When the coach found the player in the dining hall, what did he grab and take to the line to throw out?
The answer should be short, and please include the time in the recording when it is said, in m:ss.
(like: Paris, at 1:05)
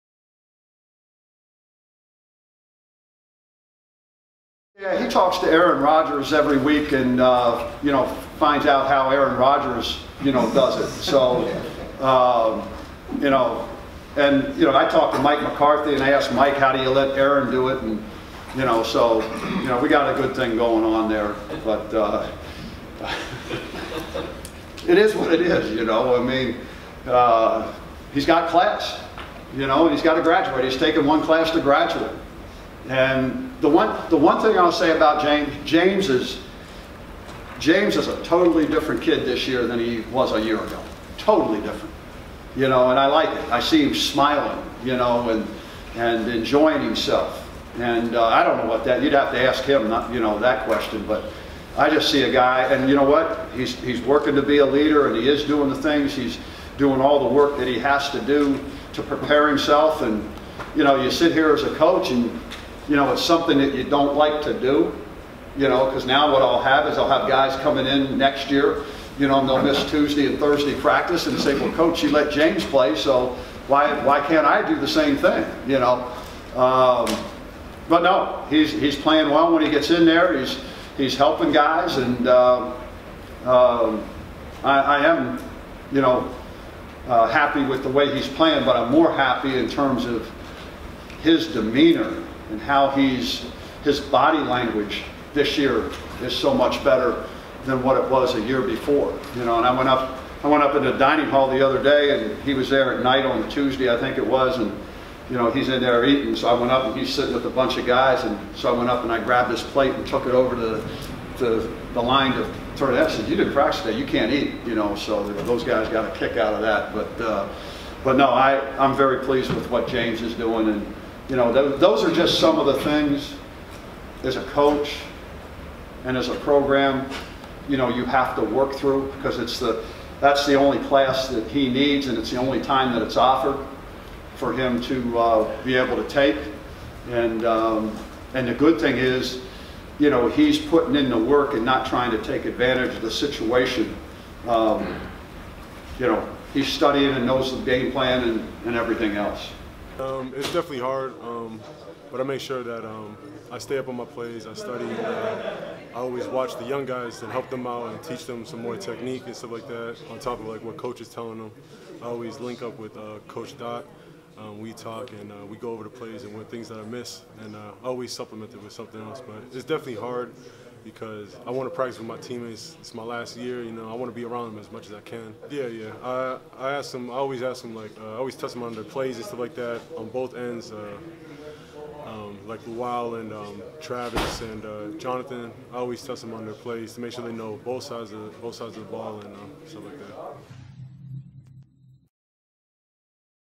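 His plate, at 1:49.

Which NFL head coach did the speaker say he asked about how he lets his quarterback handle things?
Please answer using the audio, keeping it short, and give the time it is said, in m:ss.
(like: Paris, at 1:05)
Mike McCarthy, at 0:15.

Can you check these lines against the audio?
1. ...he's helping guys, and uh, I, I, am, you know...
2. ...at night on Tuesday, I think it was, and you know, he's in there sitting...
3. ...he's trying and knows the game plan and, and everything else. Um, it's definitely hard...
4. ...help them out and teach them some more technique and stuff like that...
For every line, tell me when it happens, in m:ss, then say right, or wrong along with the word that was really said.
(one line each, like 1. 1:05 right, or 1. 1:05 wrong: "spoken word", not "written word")
1. 1:20 right
2. 1:42 wrong: "eating", not "sitting"
3. 2:26 wrong: "studying", not "trying"
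4. 2:37 right.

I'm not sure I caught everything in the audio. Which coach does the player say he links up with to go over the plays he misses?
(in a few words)
Coach Dot.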